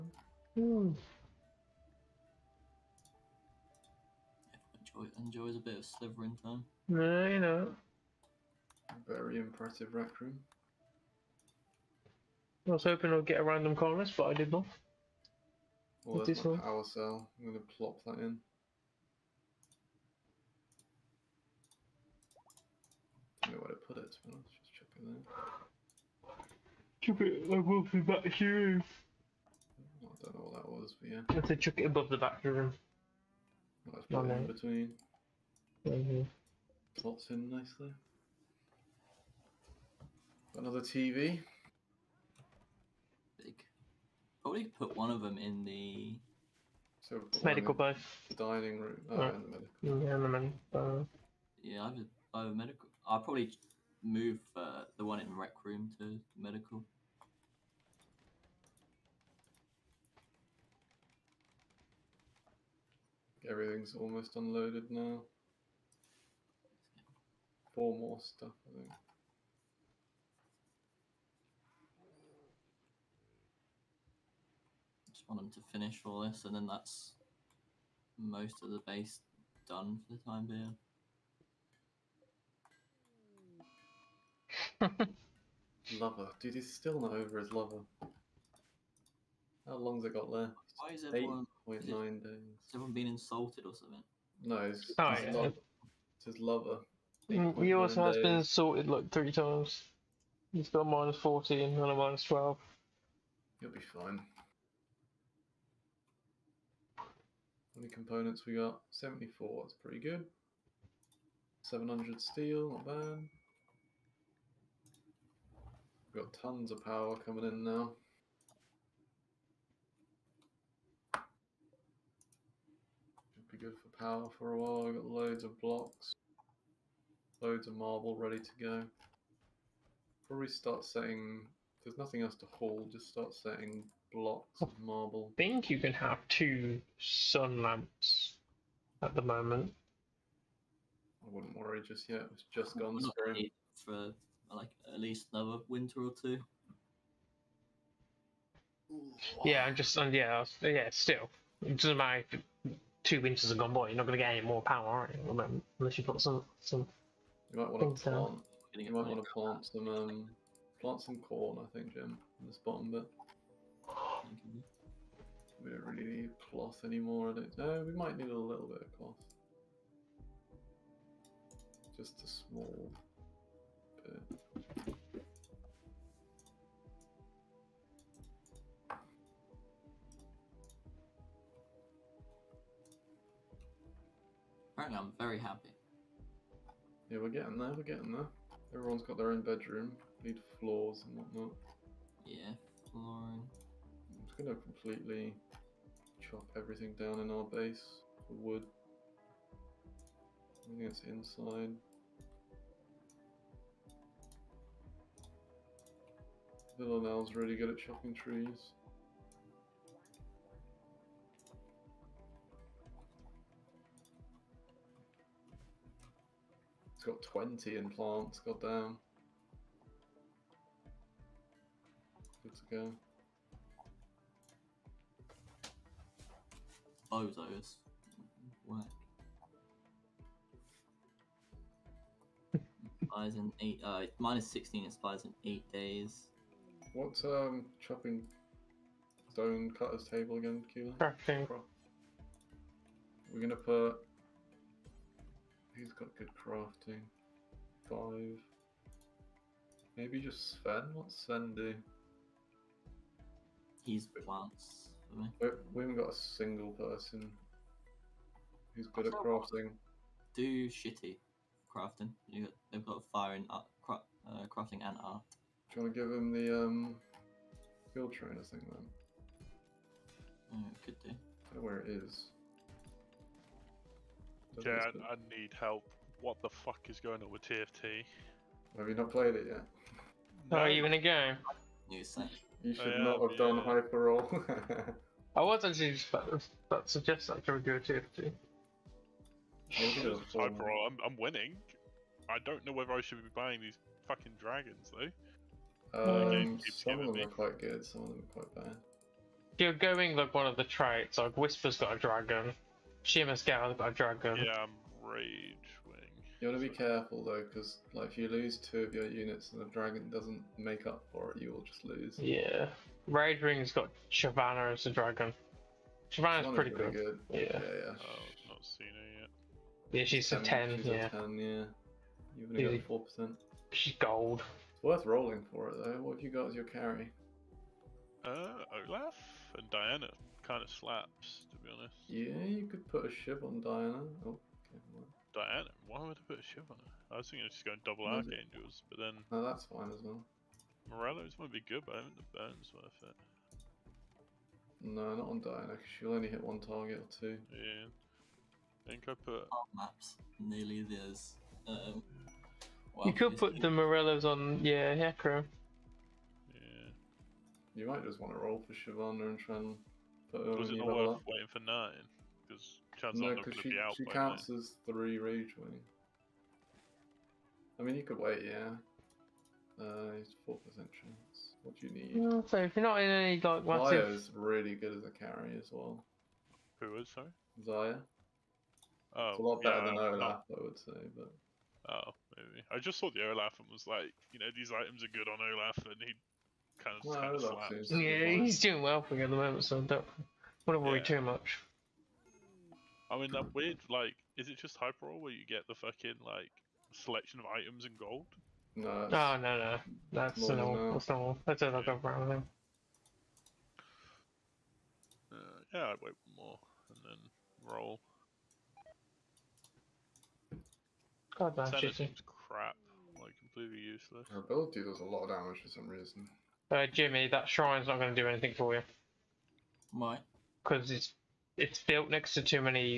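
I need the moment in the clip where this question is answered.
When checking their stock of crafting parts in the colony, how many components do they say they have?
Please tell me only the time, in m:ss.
1:48.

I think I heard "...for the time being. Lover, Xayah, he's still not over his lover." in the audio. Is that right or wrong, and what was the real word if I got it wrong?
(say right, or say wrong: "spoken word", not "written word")
wrong: "Dude", not "Xayah".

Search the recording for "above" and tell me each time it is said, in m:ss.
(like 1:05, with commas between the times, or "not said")
0:27, 0:31.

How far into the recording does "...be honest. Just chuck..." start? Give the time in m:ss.
0:24.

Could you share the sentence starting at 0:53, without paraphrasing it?
I probably move uh, the one in rec room to medical.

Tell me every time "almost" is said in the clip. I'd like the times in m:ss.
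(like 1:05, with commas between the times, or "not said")
1:03.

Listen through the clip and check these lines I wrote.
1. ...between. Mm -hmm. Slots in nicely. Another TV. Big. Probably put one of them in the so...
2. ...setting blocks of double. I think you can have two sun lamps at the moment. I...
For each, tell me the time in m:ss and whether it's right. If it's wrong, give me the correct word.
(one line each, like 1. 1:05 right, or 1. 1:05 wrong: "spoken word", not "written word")
1. 0:34 right
2. 2:13 wrong: "marble", not "double".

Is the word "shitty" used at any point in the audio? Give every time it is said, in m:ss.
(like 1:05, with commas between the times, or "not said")
4:20, 6:51.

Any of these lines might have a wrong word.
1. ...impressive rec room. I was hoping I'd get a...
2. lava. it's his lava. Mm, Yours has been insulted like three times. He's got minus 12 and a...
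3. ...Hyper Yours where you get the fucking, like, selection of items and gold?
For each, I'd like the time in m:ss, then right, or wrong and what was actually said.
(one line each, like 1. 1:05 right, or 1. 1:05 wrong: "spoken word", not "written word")
1. 0:09 right
2. 1:35 wrong: "14", not "12"
3. 6:34 wrong: "Roll", not "Yours".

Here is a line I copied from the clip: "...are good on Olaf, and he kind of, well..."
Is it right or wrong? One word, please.
right.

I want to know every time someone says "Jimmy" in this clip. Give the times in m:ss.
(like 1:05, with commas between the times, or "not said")
6:56.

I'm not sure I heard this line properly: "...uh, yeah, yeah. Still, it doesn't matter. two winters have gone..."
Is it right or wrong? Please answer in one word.
right.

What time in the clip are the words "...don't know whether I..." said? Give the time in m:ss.
4:52.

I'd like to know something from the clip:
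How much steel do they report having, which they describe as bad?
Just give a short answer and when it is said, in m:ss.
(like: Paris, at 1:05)
700, at 1:51.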